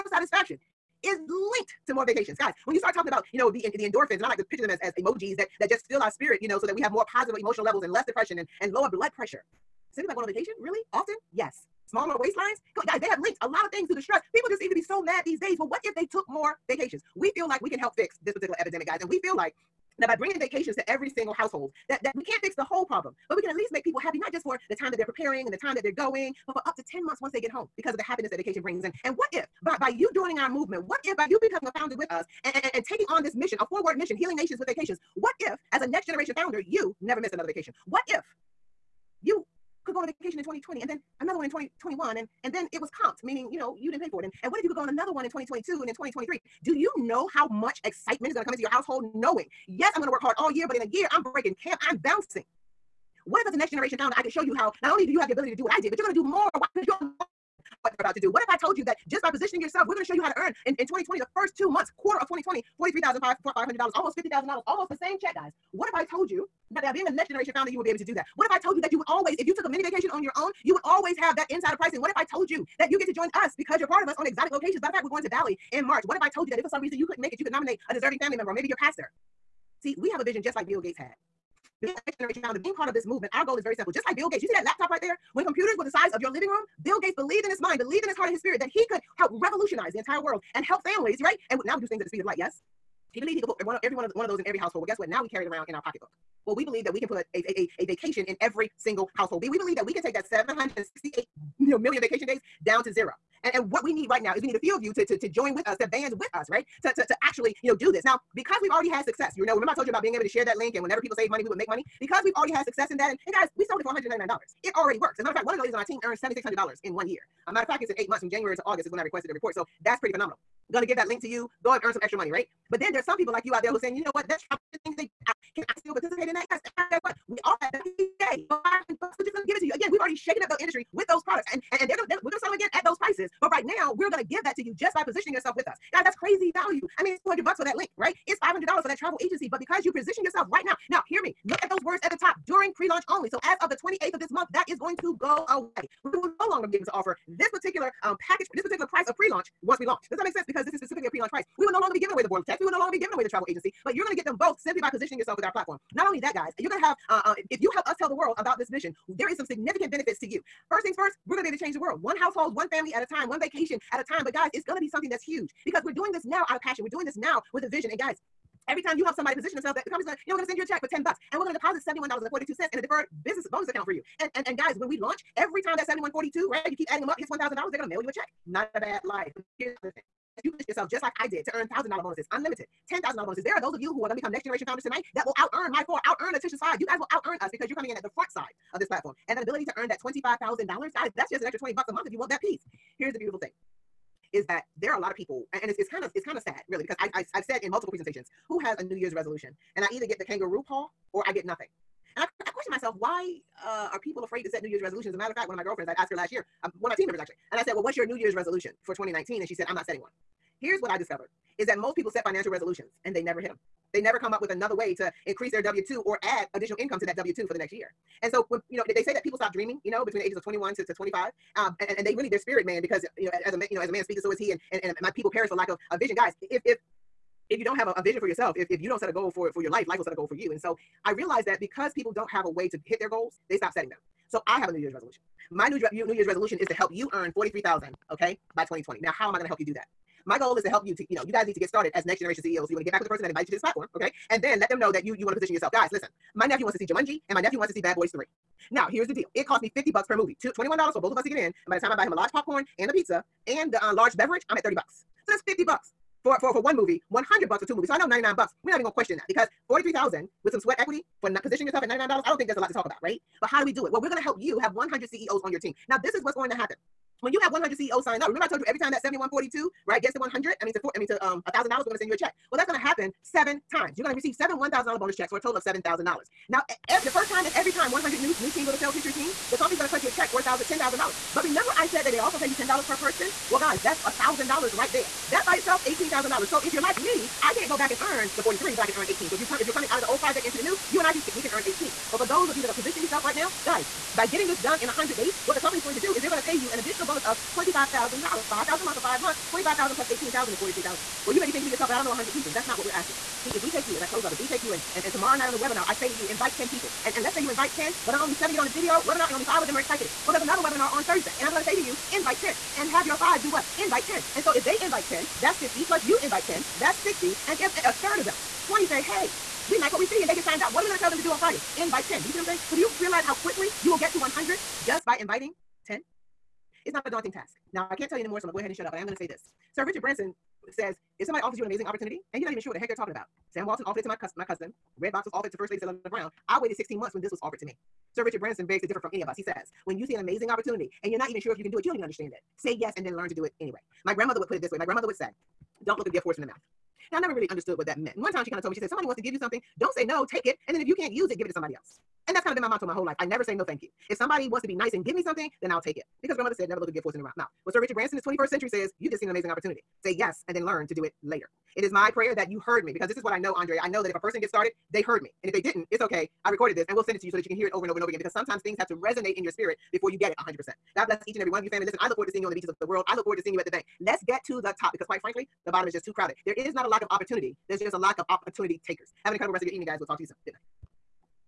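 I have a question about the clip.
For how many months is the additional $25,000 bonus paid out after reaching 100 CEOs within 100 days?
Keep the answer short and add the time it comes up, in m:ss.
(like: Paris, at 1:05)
5 months, at 4:59.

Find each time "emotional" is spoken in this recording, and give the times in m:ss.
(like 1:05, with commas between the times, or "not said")
0:07.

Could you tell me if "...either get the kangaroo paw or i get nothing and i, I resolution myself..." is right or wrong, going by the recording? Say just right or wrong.
wrong.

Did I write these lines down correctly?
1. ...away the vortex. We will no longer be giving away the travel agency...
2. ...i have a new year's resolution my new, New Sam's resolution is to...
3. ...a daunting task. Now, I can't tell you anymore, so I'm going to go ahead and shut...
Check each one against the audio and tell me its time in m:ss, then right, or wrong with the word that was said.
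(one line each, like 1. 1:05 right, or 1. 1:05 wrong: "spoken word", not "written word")
1. 2:32 right
2. 3:54 wrong: "Year", not "Sam"
3. 5:27 right.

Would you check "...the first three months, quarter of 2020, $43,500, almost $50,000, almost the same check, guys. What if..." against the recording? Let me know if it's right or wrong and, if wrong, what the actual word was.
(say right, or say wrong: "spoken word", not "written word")
wrong: "two", not "three".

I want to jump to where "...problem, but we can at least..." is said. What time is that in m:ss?
0:22.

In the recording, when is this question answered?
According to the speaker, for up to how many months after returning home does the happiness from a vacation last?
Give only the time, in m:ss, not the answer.
0:26.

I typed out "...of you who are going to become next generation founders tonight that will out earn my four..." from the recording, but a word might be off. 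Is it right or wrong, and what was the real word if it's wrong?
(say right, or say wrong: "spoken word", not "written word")
right.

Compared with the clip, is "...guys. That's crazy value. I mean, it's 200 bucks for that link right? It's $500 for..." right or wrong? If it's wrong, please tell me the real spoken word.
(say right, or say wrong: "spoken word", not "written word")
right.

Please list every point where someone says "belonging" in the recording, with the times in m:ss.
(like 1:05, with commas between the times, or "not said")
not said.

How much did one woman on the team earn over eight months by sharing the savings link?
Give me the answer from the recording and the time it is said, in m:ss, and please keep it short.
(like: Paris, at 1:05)
$7,600, at 1:56.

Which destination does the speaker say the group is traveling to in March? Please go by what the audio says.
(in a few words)
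Bali.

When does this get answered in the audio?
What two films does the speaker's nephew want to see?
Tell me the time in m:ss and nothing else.
4:06.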